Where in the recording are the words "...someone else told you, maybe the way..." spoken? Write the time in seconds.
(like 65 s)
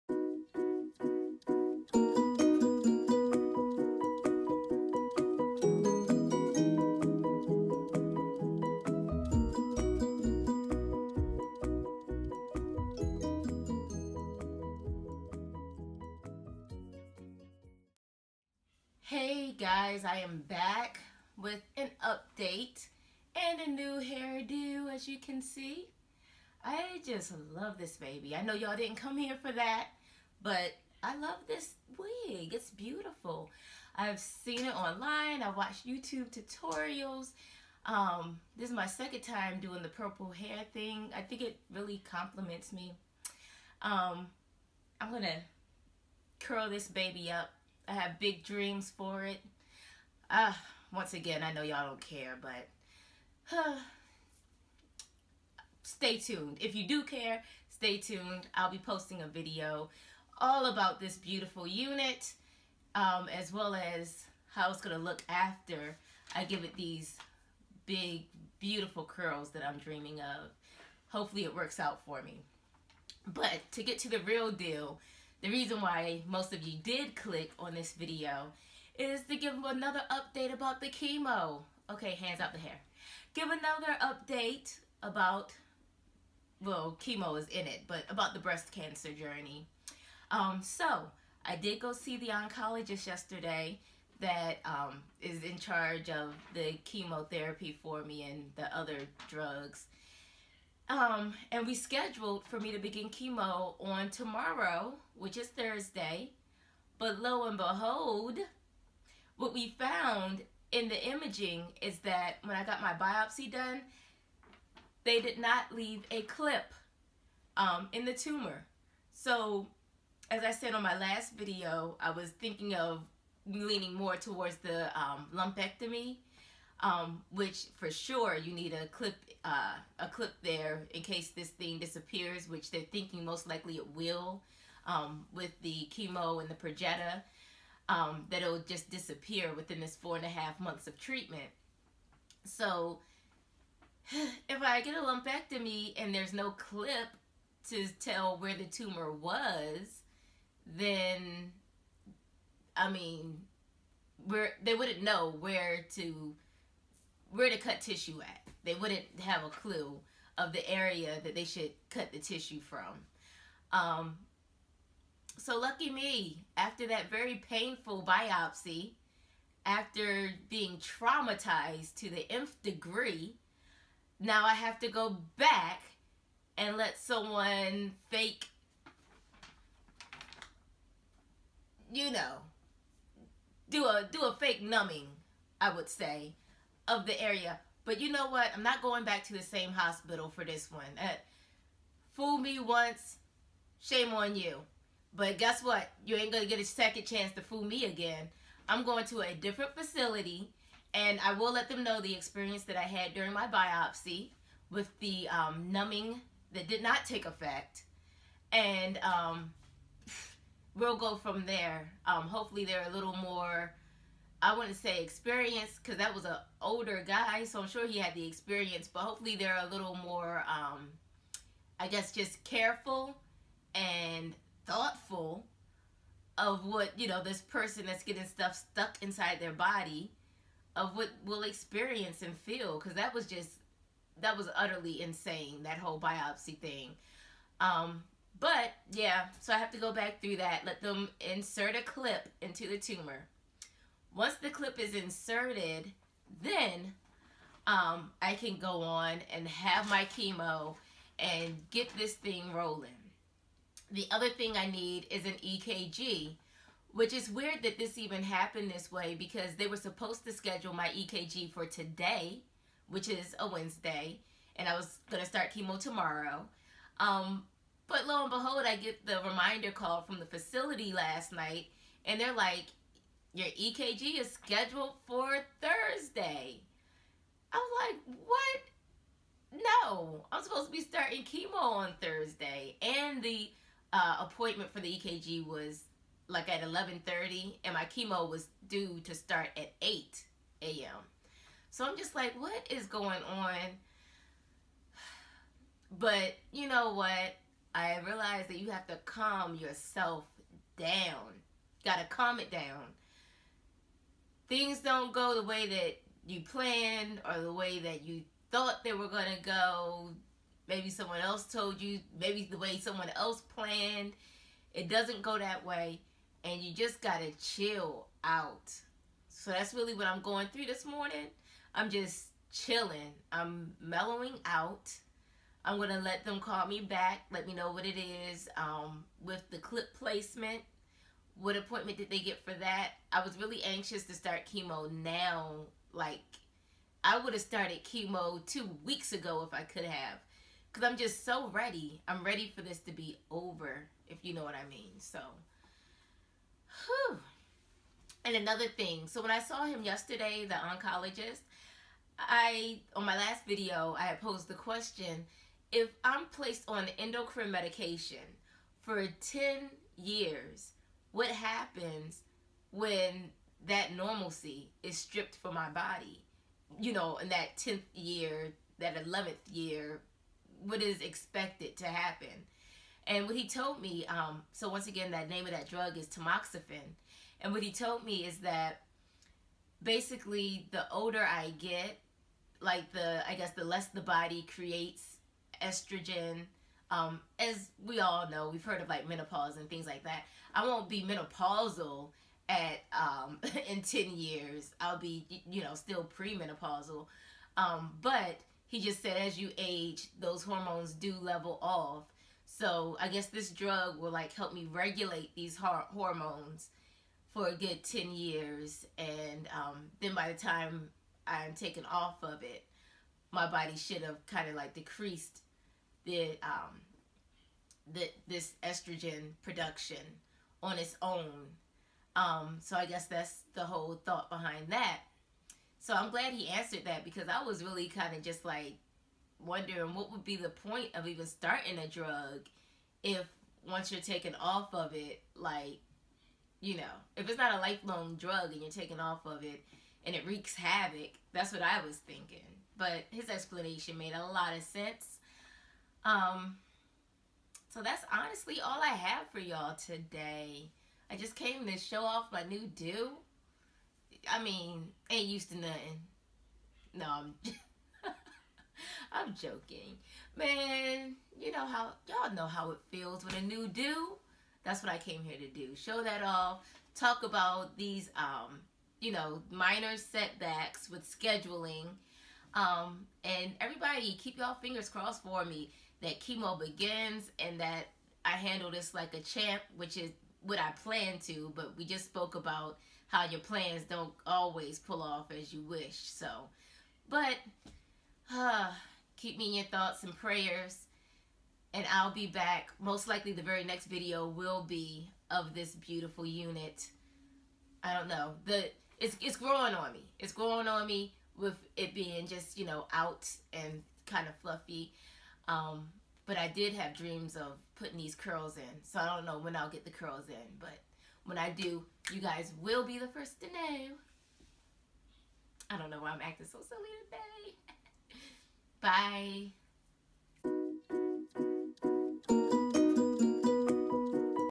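310 s.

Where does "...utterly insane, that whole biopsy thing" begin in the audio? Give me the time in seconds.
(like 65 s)
234 s.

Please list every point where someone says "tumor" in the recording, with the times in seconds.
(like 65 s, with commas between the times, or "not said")
118 s, 148 s, 242 s.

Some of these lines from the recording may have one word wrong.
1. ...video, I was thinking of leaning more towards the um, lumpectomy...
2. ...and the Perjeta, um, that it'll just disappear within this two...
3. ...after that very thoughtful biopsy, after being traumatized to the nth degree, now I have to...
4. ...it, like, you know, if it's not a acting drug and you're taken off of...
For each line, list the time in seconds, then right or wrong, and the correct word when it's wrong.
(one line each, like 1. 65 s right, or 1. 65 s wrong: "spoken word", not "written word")
1. 121 s right
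2. 136 s wrong: "four", not "two"
3. 166 s wrong: "painful", not "thoughtful"
4. 434 s wrong: "lifelong", not "acting".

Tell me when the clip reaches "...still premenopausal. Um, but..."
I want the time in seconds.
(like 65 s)
395 s.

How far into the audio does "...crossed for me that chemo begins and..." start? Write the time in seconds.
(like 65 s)
474 s.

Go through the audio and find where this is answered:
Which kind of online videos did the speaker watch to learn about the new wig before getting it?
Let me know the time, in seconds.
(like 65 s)
35 s.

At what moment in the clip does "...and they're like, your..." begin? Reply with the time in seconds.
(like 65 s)
272 s.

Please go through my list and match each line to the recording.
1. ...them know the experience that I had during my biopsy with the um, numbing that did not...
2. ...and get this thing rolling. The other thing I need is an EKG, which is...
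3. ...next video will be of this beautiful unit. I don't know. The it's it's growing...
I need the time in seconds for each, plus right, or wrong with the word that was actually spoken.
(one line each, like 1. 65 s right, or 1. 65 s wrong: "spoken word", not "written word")
1. 201 s right
2. 251 s right
3. 493 s right.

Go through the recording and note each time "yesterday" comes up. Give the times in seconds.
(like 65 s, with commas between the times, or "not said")
93 s, 349 s.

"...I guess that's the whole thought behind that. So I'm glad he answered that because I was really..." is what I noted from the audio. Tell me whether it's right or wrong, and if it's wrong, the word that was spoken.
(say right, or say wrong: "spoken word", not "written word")
right.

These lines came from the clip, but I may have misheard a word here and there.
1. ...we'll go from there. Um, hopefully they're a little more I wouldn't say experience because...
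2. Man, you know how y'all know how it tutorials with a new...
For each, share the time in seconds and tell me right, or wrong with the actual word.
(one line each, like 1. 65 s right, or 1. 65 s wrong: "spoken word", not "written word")
1. 210 s right
2. 460 s wrong: "feels", not "tutorials".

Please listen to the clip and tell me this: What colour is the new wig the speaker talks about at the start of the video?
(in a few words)
Purple.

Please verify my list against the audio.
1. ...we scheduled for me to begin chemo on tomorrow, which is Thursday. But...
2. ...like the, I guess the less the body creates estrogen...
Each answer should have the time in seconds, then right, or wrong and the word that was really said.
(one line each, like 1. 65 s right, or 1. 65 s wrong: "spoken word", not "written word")
1. 101 s right
2. 382 s right.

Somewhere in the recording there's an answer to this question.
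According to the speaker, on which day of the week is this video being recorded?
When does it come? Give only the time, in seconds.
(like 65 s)
263 s.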